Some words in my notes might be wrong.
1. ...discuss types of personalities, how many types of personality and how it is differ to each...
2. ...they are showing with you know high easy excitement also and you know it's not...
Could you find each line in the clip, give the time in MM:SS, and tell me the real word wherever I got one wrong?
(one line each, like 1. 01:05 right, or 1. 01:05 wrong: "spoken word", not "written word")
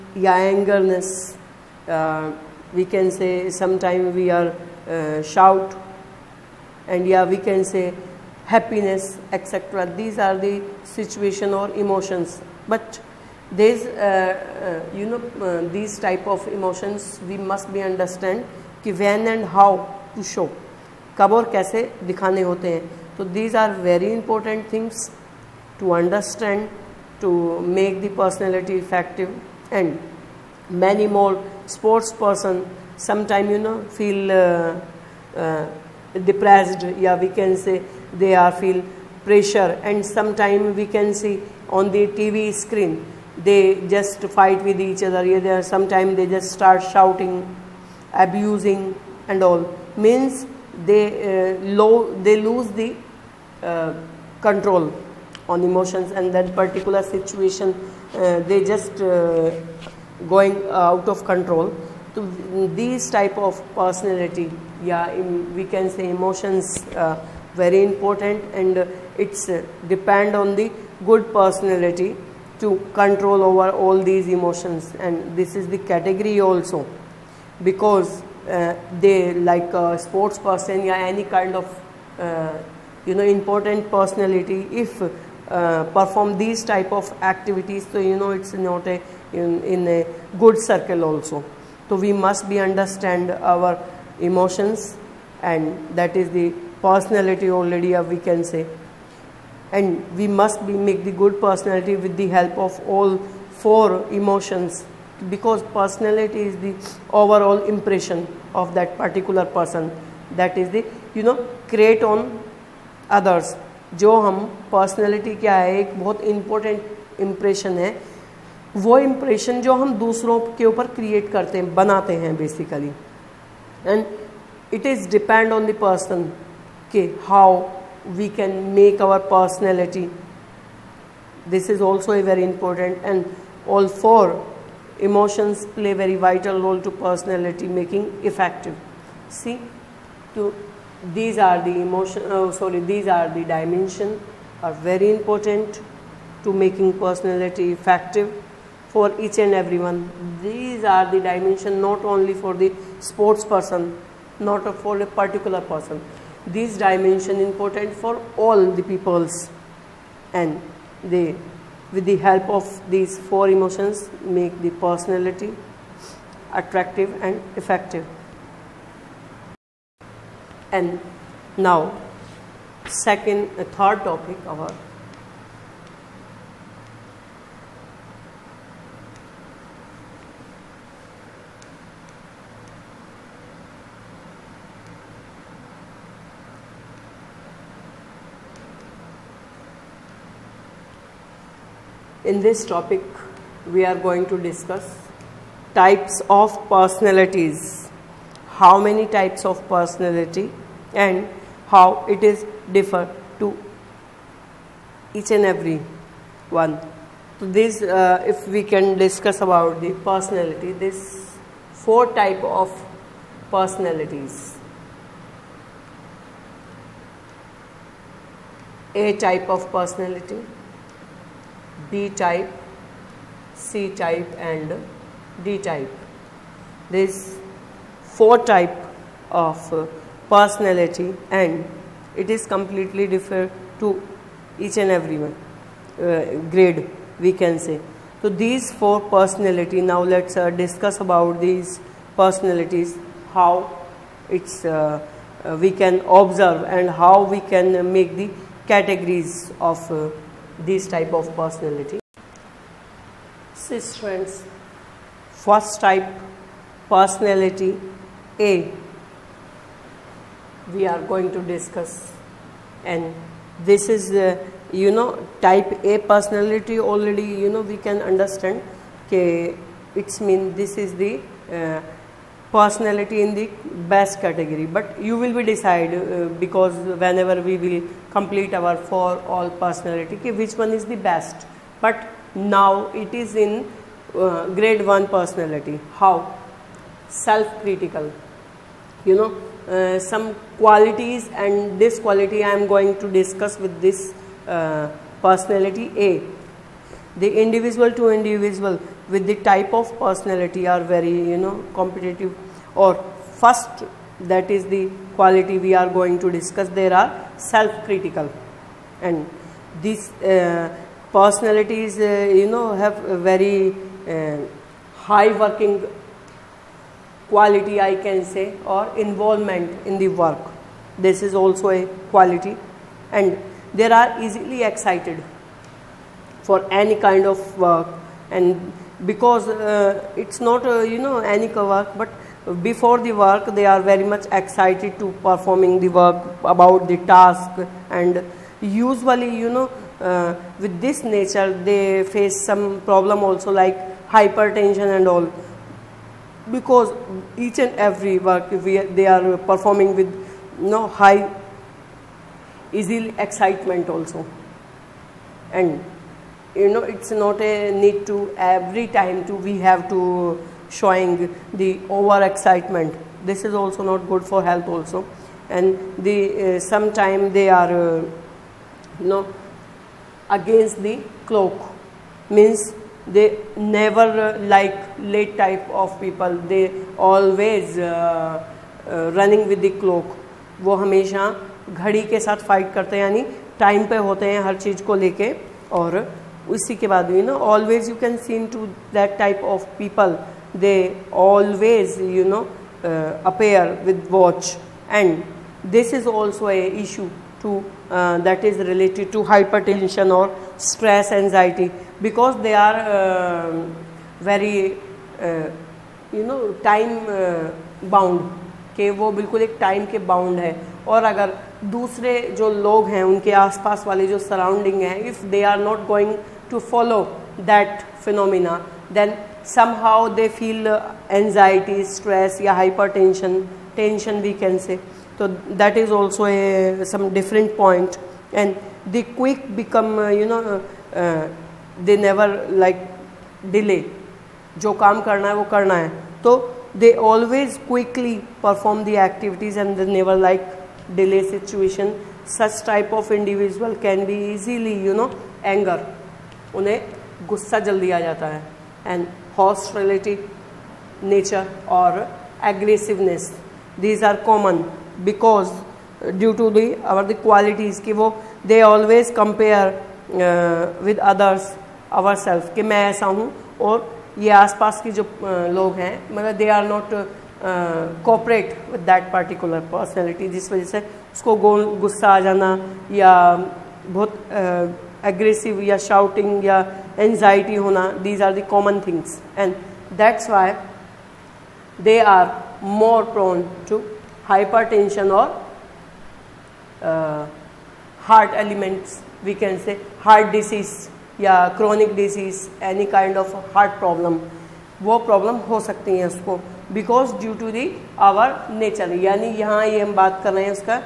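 1. 03:14 right
2. 05:48 wrong: "performing", not "showing".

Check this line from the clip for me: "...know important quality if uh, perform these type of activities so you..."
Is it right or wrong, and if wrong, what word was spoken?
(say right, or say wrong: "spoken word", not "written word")
wrong: "personality", not "quality".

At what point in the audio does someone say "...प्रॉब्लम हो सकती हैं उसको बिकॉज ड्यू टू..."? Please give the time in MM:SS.
08:15.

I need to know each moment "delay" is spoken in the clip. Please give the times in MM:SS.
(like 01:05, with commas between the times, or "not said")
07:13, 07:21.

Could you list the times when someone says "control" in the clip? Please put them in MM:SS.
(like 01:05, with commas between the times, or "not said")
00:54, 01:01, 01:12.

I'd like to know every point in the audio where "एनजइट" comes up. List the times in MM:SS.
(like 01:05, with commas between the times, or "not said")
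06:41.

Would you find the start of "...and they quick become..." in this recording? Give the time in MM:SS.
07:08.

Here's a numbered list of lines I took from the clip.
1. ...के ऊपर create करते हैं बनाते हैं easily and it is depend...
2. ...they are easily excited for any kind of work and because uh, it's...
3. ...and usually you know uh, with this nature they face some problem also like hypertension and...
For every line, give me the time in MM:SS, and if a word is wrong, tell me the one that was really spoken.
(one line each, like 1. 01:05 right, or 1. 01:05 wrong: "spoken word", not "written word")
1. 02:00 wrong: "basically", not "easily"
2. 05:23 right
3. 05:37 right.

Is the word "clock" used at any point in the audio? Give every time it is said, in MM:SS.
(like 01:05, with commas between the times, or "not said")
06:11, 06:19.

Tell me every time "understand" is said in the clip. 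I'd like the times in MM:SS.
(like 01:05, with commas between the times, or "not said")
00:17, 00:25, 01:32, 04:28.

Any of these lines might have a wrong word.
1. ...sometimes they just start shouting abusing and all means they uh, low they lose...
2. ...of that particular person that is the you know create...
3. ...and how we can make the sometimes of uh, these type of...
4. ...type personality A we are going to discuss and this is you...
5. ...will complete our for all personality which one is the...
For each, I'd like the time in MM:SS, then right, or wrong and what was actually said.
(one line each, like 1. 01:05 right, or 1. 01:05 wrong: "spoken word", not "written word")
1. 00:45 right
2. 01:48 right
3. 04:06 wrong: "categories", not "sometimes"
4. 04:15 right
5. 04:37 right.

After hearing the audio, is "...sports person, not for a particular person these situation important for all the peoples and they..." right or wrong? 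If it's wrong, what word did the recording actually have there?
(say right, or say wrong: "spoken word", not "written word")
wrong: "dimension", not "situation".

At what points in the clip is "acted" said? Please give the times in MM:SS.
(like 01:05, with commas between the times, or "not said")
not said.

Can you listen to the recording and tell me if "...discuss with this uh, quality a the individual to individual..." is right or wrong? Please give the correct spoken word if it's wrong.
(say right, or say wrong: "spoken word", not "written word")
wrong: "personality", not "quality".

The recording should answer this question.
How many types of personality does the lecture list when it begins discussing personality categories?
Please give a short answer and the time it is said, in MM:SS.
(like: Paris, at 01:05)
4, at 03:31.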